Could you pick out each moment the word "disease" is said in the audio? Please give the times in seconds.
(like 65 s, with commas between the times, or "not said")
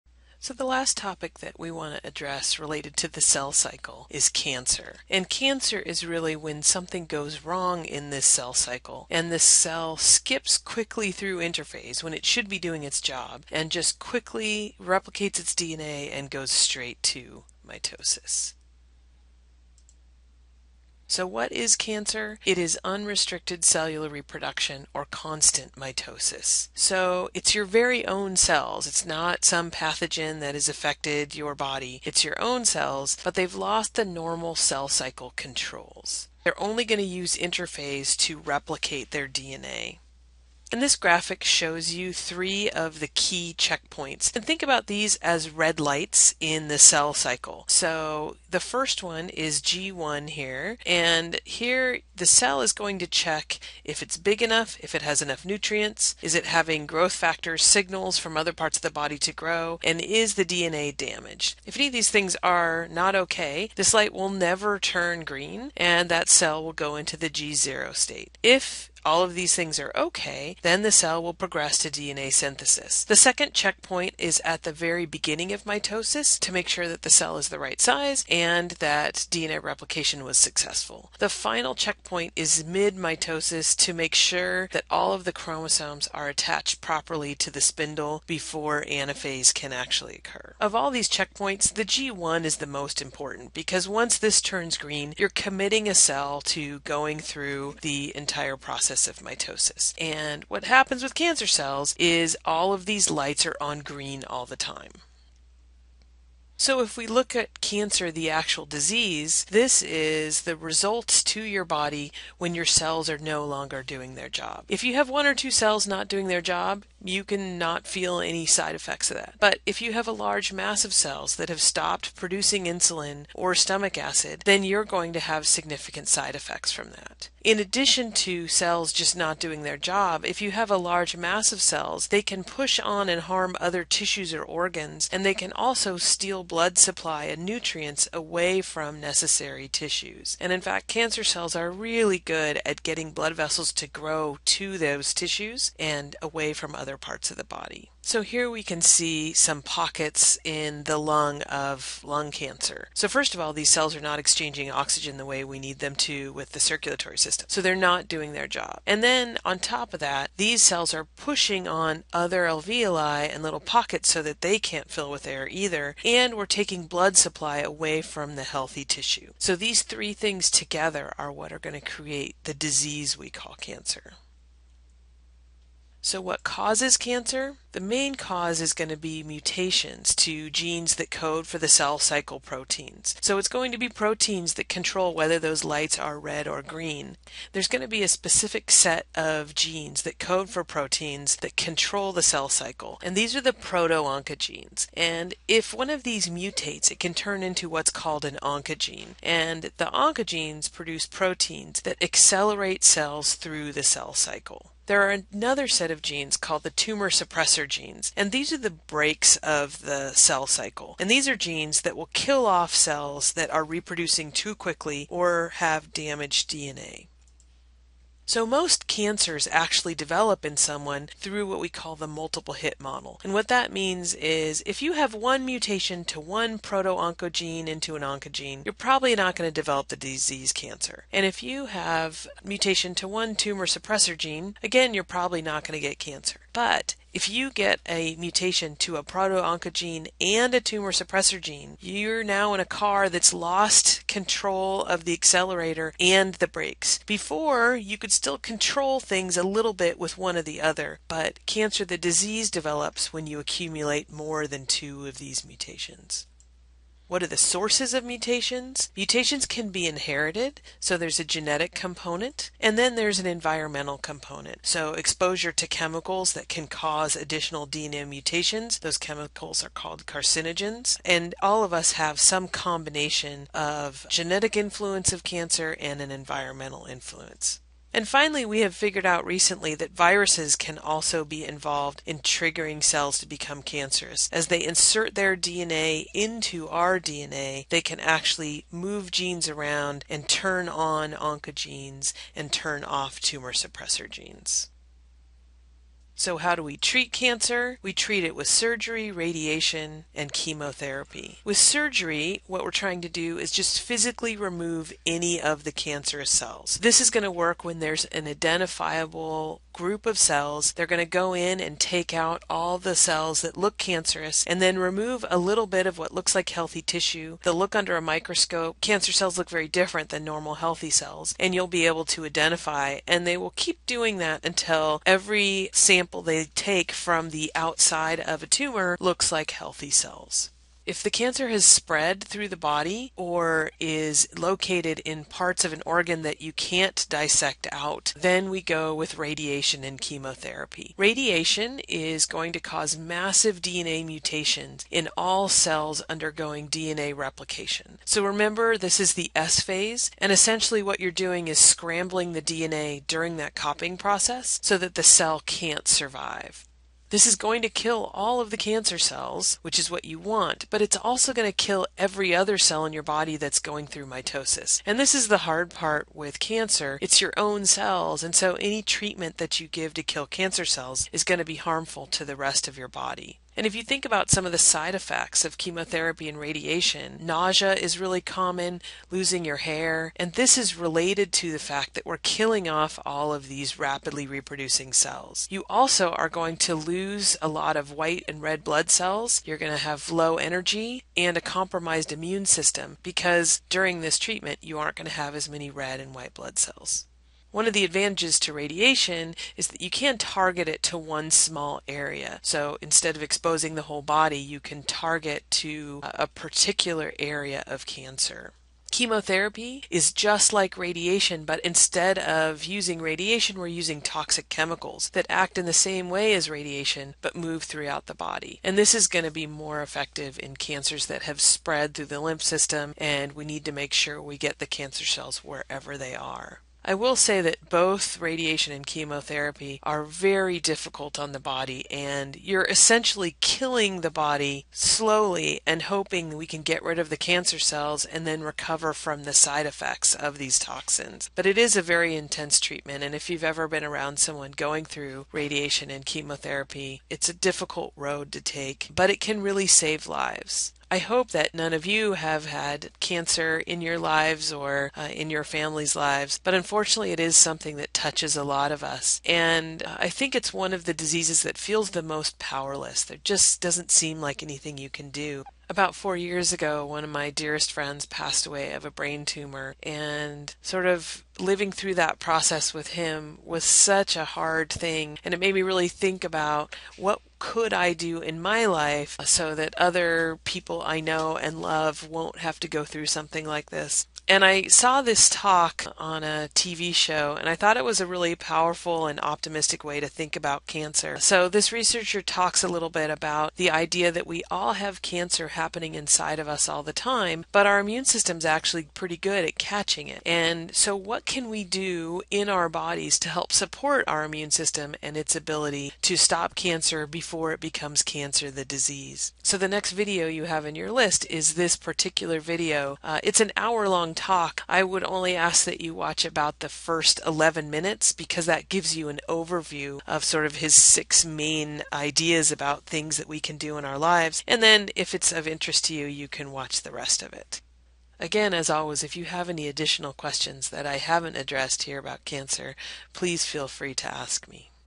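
108 s, 172 s, 229 s, 251 s, 460 s, 508 s.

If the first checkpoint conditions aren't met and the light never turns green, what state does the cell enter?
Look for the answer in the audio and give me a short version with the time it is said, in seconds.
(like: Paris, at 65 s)
G0 state, at 67 s.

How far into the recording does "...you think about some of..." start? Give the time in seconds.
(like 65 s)
373 s.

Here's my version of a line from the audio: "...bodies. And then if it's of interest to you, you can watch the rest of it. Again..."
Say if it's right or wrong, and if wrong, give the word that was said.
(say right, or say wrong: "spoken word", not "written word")
wrong: "lives", not "bodies".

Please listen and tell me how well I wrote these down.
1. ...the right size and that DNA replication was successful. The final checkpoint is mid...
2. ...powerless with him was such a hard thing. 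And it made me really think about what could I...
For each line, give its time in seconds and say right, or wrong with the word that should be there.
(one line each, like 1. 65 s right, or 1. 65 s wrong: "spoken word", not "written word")
1. 77 s right
2. 472 s wrong: "process", not "powerless".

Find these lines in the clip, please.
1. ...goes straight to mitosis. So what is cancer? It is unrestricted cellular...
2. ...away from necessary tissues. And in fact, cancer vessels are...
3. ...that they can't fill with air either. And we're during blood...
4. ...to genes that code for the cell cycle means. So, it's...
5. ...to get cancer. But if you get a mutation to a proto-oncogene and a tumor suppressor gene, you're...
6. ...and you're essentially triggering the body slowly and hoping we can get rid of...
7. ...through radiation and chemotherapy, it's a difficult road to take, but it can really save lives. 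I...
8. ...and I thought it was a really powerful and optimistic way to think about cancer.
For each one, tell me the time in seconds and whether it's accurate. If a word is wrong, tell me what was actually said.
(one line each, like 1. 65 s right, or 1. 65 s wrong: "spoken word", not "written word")
1. 16 s right
2. 138 s wrong: "cells", not "vessels"
3. 164 s wrong: "taking", not "during"
4. 180 s wrong: "proteins", not "means"
5. 235 s right
6. 431 s wrong: "killing", not "triggering"
7. 444 s right
8. 487 s right.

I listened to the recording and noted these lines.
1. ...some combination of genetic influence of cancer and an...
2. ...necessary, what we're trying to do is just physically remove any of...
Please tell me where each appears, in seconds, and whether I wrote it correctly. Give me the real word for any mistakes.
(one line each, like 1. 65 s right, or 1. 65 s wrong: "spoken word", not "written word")
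1. 272 s right
2. 301 s wrong: "surgery", not "necessary".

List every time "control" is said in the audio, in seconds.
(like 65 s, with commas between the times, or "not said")
35 s, 184 s, 191 s, 244 s, 248 s.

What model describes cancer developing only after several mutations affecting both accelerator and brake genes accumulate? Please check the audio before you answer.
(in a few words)
multiple hit model.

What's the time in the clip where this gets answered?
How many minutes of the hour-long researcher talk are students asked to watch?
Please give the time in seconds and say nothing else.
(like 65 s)
517 s.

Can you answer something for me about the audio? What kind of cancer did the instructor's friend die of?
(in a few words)
brain tumor.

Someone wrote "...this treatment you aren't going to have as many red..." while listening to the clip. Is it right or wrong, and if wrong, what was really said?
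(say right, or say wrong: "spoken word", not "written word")
right.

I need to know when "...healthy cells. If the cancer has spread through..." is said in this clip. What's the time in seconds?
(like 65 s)
329 s.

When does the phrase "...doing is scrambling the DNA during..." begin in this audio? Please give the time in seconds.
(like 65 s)
351 s.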